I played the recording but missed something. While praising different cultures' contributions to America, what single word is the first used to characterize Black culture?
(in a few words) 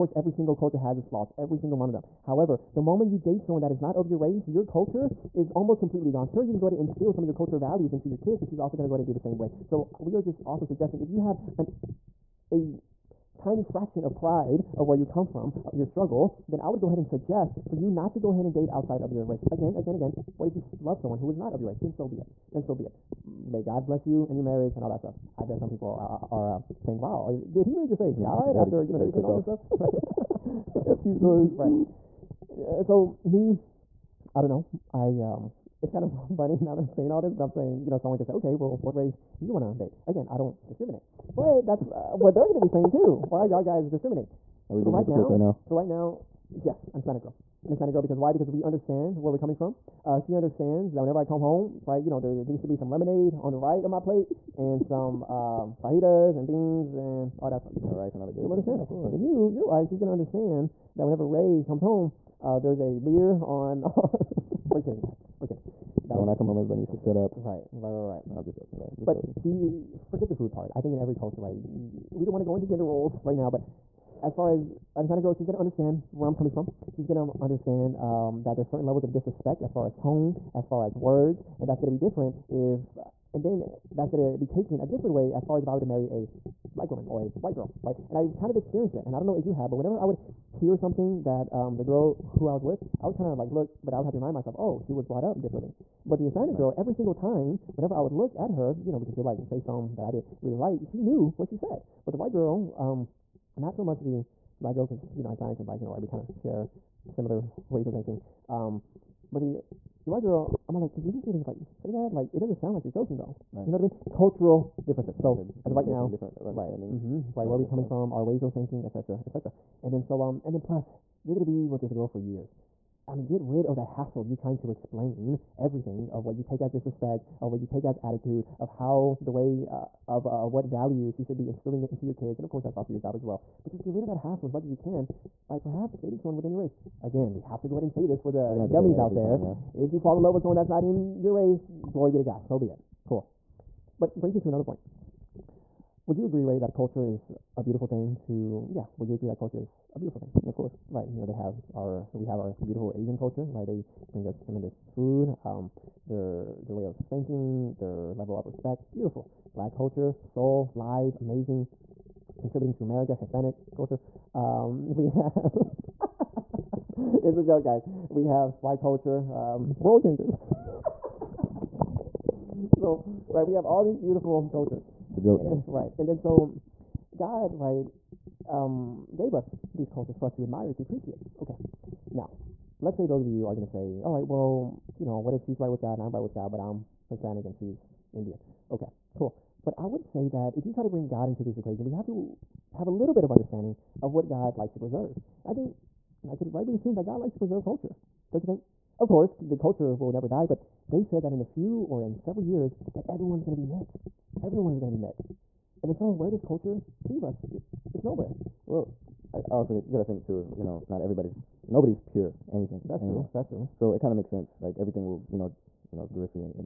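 Soul.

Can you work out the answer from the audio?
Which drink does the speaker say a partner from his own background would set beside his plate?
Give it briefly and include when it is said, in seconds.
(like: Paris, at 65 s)
Lemonade, at 52 s.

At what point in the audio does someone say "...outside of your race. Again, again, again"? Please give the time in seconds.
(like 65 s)
18 s.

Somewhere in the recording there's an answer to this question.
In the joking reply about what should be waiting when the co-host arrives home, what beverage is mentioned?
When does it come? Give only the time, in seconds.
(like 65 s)
62 s.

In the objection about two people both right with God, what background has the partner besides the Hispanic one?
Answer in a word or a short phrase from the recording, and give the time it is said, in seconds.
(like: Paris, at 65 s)
Indian, at 188 s.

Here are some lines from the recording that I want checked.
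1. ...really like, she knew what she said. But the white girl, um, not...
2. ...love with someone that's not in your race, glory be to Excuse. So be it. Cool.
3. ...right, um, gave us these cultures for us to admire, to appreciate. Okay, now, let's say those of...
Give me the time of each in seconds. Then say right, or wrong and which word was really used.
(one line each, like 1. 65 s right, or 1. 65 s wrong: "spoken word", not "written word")
1. 100 s right
2. 140 s wrong: "God", not "Excuse"
3. 177 s right.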